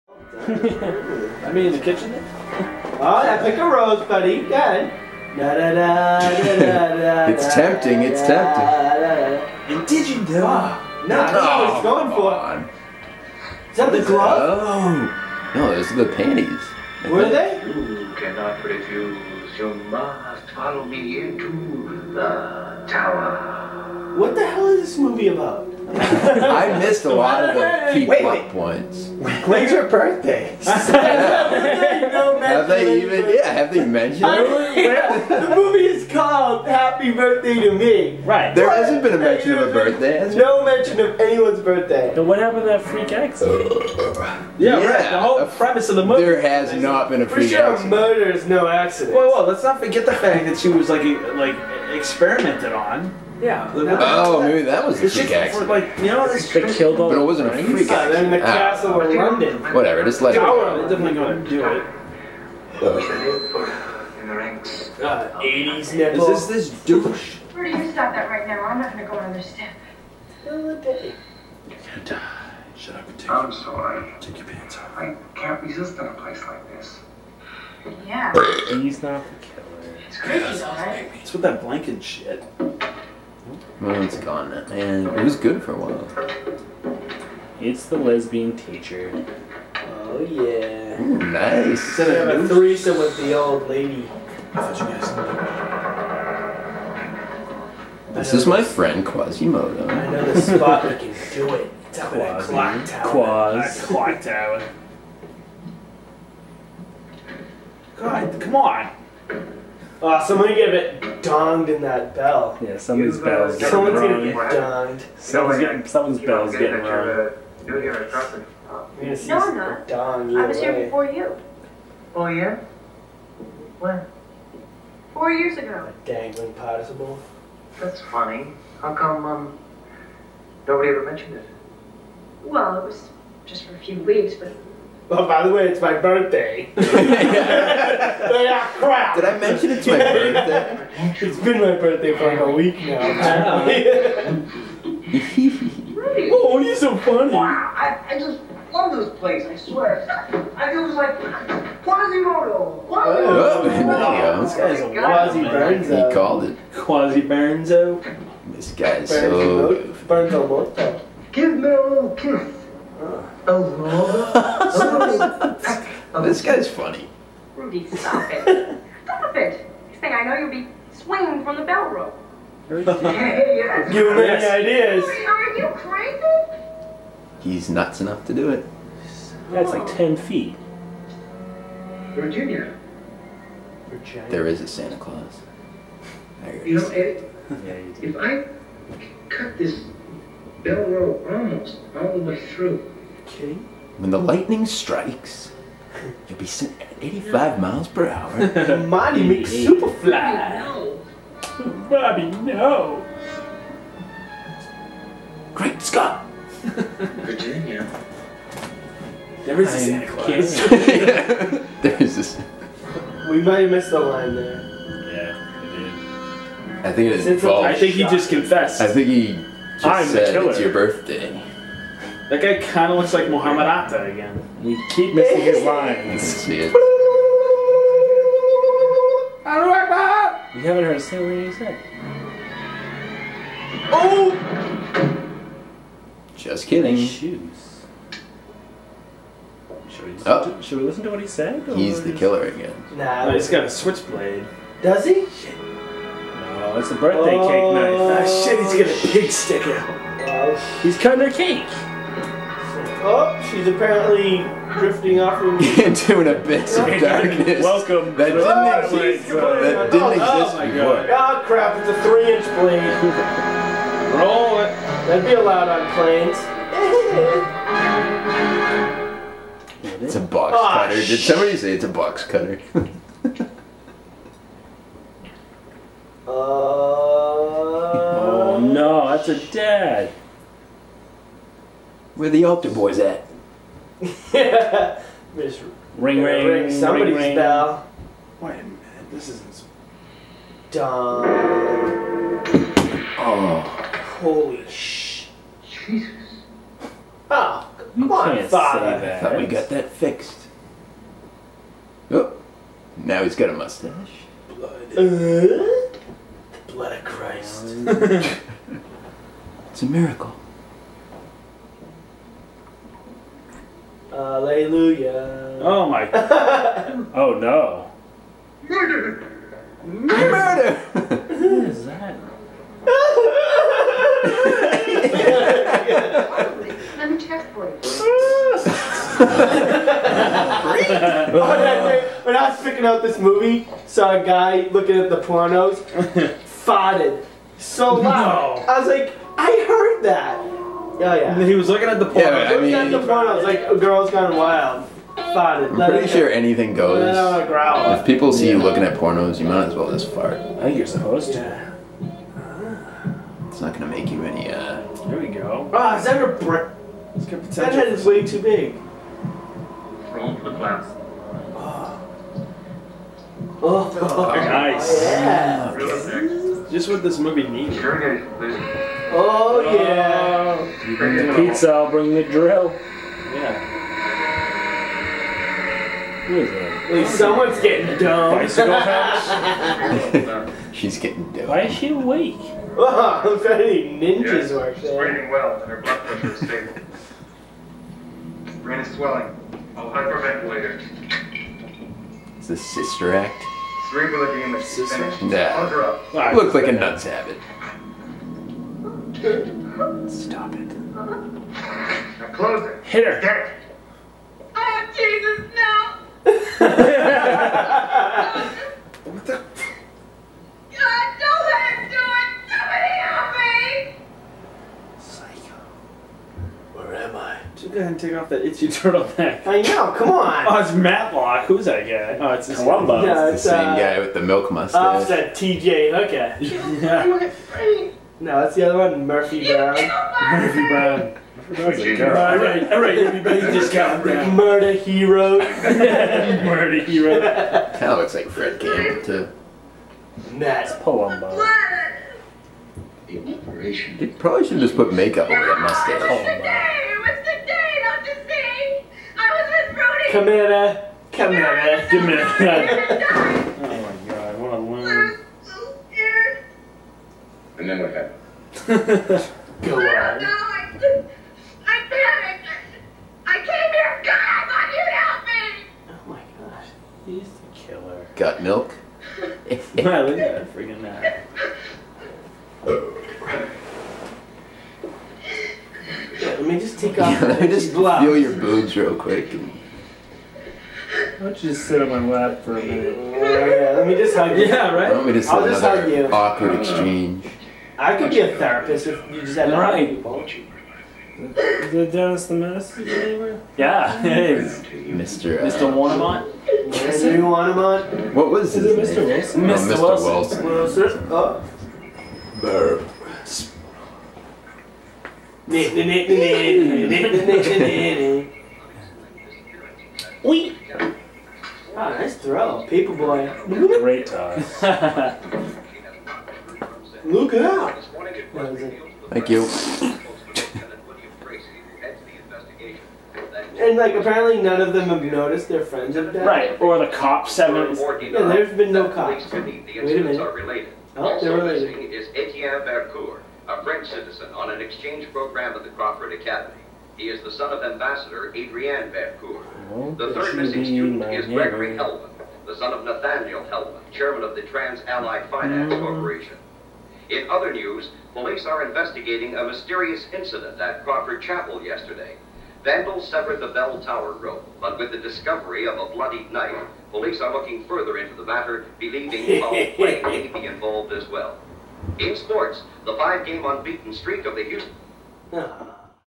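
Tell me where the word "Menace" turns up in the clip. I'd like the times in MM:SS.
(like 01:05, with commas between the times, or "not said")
08:12.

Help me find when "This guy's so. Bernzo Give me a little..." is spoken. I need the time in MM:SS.
02:38.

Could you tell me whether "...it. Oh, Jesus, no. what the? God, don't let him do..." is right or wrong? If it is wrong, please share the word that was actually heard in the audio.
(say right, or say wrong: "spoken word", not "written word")
right.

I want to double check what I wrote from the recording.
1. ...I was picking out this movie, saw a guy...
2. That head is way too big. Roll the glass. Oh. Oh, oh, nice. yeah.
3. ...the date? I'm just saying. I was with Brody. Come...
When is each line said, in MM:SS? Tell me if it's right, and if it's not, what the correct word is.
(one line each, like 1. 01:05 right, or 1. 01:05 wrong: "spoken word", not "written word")
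1. 05:32 right
2. 05:57 right
3. 07:27 right.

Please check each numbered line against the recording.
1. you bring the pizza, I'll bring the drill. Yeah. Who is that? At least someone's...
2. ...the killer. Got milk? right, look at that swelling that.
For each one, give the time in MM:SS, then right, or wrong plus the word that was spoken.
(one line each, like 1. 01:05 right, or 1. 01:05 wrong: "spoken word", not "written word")
1. 06:10 right
2. 07:47 wrong: "freaking", not "swelling".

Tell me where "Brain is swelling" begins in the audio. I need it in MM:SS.
06:28.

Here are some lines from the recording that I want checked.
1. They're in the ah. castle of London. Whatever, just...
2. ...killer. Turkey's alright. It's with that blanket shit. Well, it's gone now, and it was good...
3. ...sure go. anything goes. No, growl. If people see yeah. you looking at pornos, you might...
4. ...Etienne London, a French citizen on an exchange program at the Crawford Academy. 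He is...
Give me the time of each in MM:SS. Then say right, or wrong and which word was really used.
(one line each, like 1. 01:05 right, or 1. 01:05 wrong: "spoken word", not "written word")
1. 00:58 right
2. 01:19 right
3. 05:46 right
4. 08:52 wrong: "Bercourt", not "London".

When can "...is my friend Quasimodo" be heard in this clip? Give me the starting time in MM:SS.
01:38.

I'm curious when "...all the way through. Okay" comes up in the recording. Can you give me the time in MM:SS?
03:11.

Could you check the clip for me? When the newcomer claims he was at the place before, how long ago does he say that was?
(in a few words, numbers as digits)
4 years ago.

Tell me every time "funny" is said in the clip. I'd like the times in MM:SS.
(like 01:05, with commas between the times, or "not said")
02:08, 02:26, 02:46.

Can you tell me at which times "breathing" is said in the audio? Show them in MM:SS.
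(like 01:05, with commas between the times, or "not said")
06:24.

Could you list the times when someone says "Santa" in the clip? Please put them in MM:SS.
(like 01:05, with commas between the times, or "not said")
03:04, 03:29.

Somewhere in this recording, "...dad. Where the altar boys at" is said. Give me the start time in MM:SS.
04:39.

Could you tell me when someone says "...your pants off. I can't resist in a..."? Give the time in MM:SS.
01:14.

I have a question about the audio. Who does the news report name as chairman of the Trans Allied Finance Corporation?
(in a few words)
Nathaniel Hellman.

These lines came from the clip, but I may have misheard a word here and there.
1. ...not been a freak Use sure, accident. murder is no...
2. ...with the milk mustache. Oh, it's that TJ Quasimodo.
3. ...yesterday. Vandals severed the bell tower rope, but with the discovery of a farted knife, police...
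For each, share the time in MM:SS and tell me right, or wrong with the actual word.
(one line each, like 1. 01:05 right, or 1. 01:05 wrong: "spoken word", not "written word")
1. 00:46 wrong: "For", not "Use"
2. 07:03 wrong: "Hooker", not "Quasimodo"
3. 09:11 wrong: "bloodied", not "farted".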